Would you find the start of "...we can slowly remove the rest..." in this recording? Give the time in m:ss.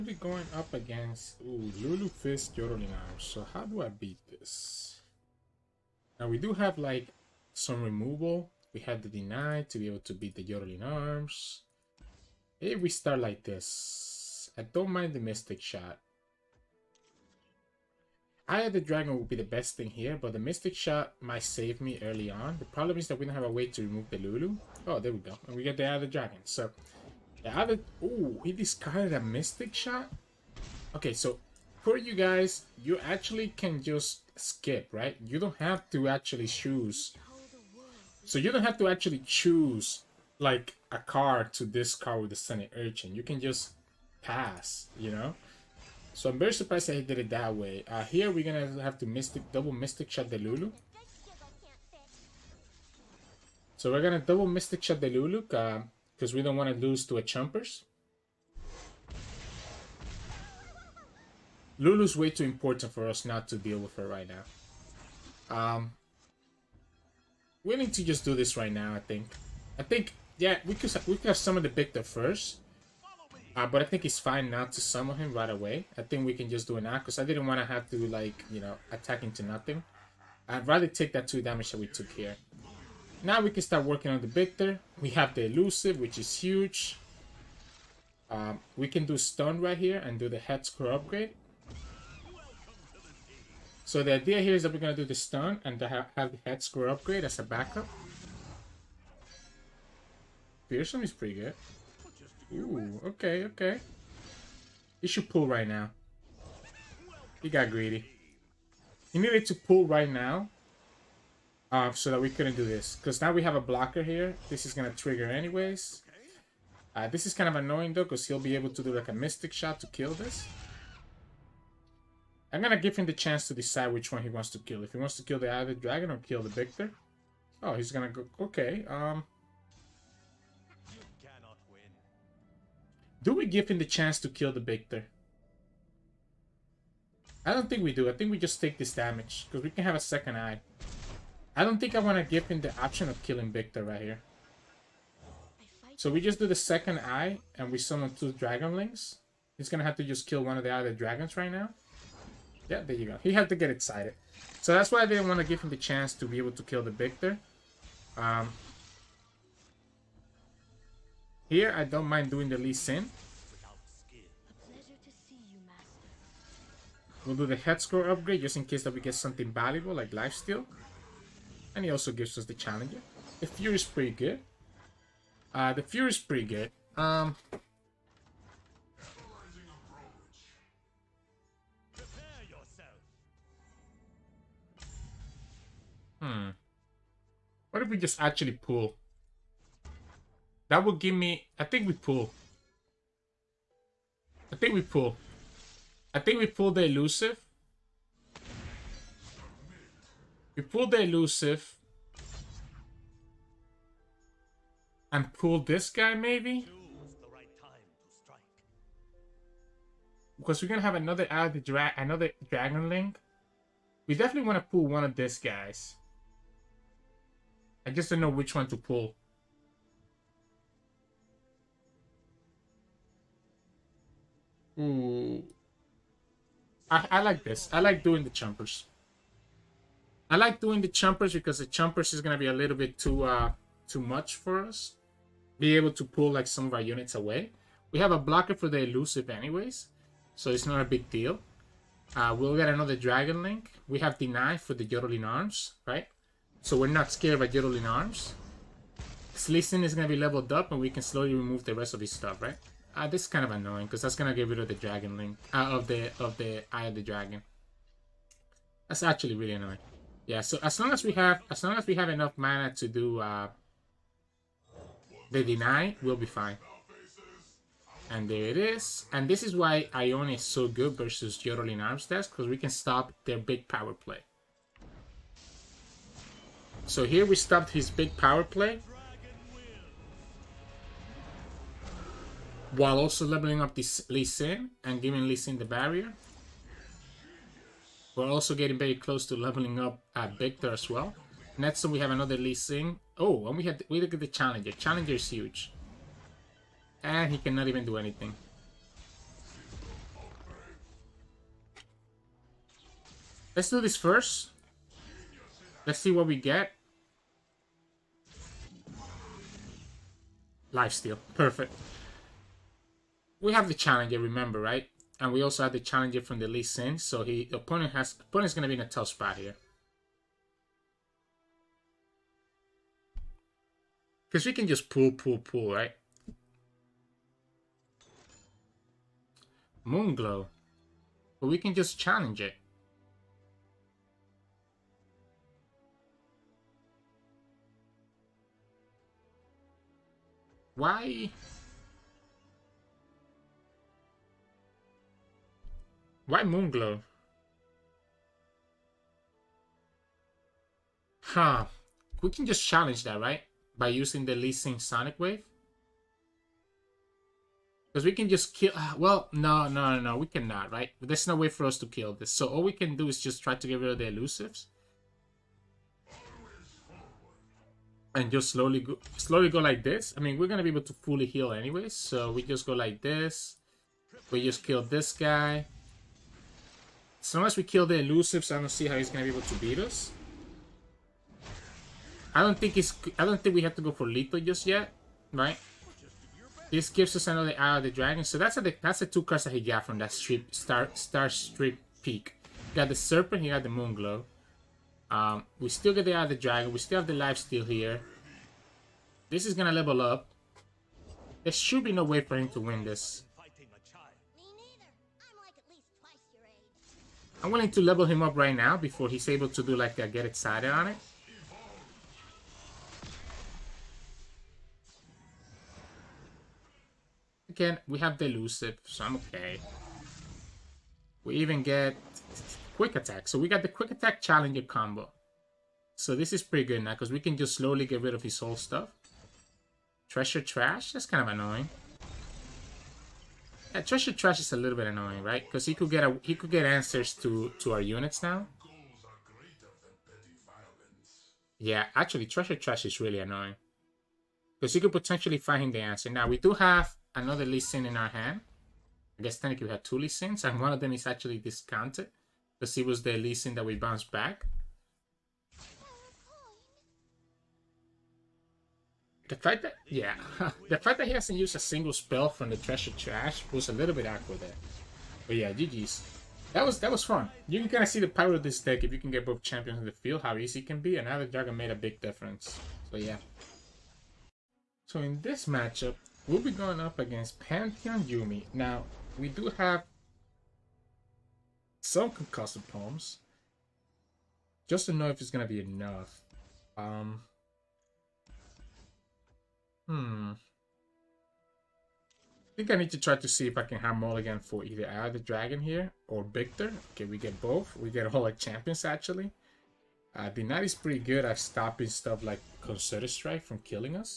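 4:10.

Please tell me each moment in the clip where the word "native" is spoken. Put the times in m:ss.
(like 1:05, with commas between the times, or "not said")
not said.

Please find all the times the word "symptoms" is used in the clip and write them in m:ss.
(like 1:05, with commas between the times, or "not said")
not said.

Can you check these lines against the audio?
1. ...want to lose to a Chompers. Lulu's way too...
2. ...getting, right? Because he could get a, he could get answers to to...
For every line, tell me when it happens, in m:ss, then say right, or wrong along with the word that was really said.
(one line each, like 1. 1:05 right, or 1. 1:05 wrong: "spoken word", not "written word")
1. 0:56 right
2. 7:14 wrong: "annoying", not "getting".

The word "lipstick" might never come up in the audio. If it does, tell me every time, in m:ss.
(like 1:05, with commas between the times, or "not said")
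not said.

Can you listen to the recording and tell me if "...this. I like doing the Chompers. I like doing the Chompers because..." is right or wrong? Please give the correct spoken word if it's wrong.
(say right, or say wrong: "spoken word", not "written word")
right.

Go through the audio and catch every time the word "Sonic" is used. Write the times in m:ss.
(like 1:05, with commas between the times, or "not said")
5:54.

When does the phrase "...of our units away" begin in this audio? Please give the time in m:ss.
3:56.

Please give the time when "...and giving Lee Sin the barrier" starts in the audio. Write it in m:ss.
4:44.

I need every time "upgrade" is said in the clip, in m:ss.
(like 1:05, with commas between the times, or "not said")
1:30, 1:36, 2:48.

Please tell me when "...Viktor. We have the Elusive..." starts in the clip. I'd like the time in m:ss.
1:24.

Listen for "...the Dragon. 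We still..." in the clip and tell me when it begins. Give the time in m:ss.
6:36.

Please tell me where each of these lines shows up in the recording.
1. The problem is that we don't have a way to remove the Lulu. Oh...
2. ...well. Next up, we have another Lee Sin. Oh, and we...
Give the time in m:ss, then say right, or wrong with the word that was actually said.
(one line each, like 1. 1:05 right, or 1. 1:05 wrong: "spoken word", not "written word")
1. 0:22 right
2. 4:50 right.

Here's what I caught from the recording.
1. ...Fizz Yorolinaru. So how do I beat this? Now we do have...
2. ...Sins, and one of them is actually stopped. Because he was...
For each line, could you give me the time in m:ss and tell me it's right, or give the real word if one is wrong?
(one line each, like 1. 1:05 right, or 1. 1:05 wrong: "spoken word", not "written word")
1. 0:02 right
2. 7:30 wrong: "discounted", not "stopped".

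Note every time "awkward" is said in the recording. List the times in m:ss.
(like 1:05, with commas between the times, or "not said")
7:44.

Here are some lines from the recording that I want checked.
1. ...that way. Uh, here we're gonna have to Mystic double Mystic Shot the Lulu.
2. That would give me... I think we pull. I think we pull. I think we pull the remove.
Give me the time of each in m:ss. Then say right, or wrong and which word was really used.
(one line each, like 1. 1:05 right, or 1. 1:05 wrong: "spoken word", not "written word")
1. 0:47 right
2. 3:10 wrong: "elusive", not "remove".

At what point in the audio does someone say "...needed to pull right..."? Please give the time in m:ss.
1:49.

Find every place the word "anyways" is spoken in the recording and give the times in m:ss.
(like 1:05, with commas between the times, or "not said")
1:55, 3:59, 6:11.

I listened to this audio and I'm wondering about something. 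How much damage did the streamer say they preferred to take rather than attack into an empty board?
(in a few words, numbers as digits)
2.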